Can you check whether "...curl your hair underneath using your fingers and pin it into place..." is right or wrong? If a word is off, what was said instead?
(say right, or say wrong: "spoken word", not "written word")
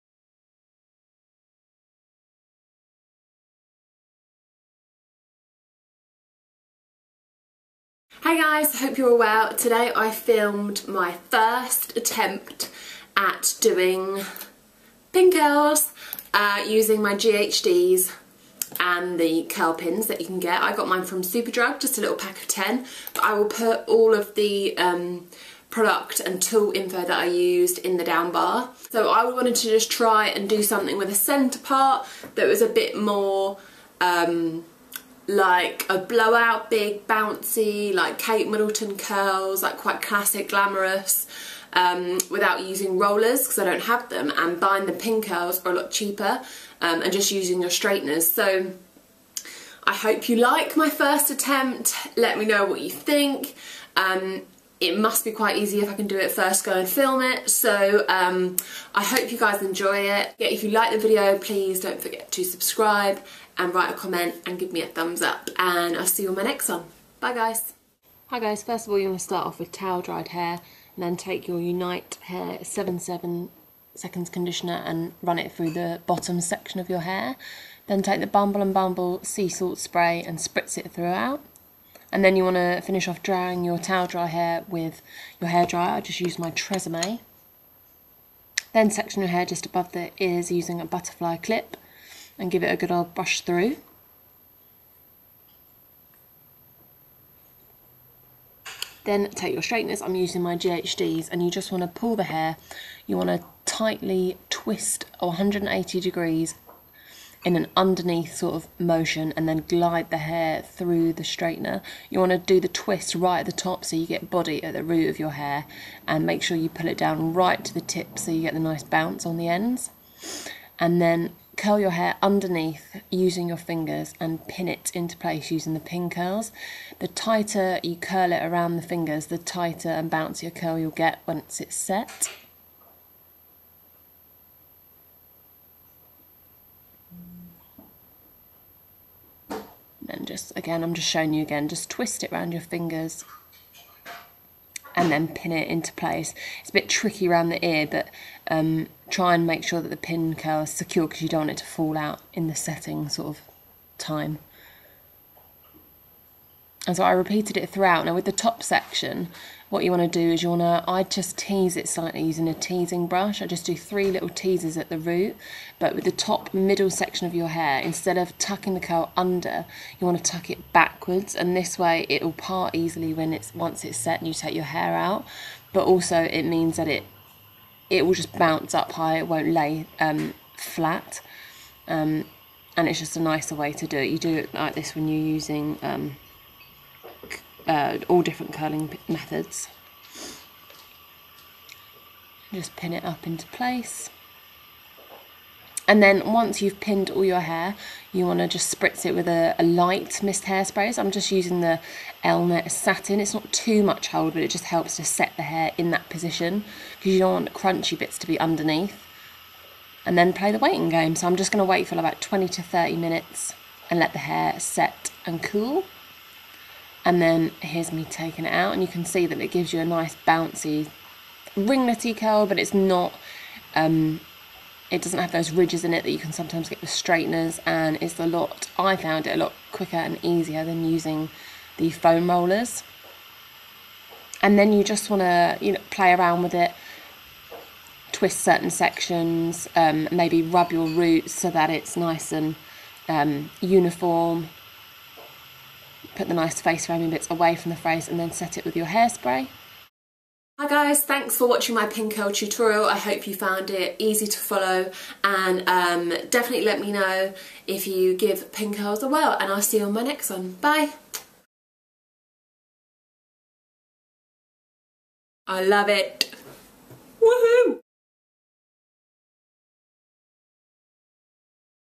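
right.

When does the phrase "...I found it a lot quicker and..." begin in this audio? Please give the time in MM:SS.
03:48.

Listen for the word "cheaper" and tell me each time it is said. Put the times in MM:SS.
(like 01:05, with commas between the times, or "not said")
00:45.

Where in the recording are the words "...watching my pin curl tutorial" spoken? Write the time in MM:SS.
04:11.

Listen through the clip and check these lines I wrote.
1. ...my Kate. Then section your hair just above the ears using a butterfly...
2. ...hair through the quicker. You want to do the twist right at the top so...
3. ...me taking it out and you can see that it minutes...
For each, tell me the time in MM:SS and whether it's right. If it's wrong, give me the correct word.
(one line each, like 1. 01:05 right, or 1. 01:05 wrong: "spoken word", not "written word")
1. 01:26 wrong: "Tresemme", not "Kate"
2. 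01:50 wrong: "straightener", not "quicker"
3. 03:37 wrong: "gives", not "minutes".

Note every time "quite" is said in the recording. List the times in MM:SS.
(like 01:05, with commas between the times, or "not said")
00:39, 00:55.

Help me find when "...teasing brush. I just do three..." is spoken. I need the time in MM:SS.
02:42.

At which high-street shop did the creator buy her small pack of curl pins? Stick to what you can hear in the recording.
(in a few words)
Superdrug.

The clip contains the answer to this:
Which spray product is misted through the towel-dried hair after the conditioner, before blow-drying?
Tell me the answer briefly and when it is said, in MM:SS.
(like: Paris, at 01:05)
Bumble and Bumble sea salt spray, at 01:18.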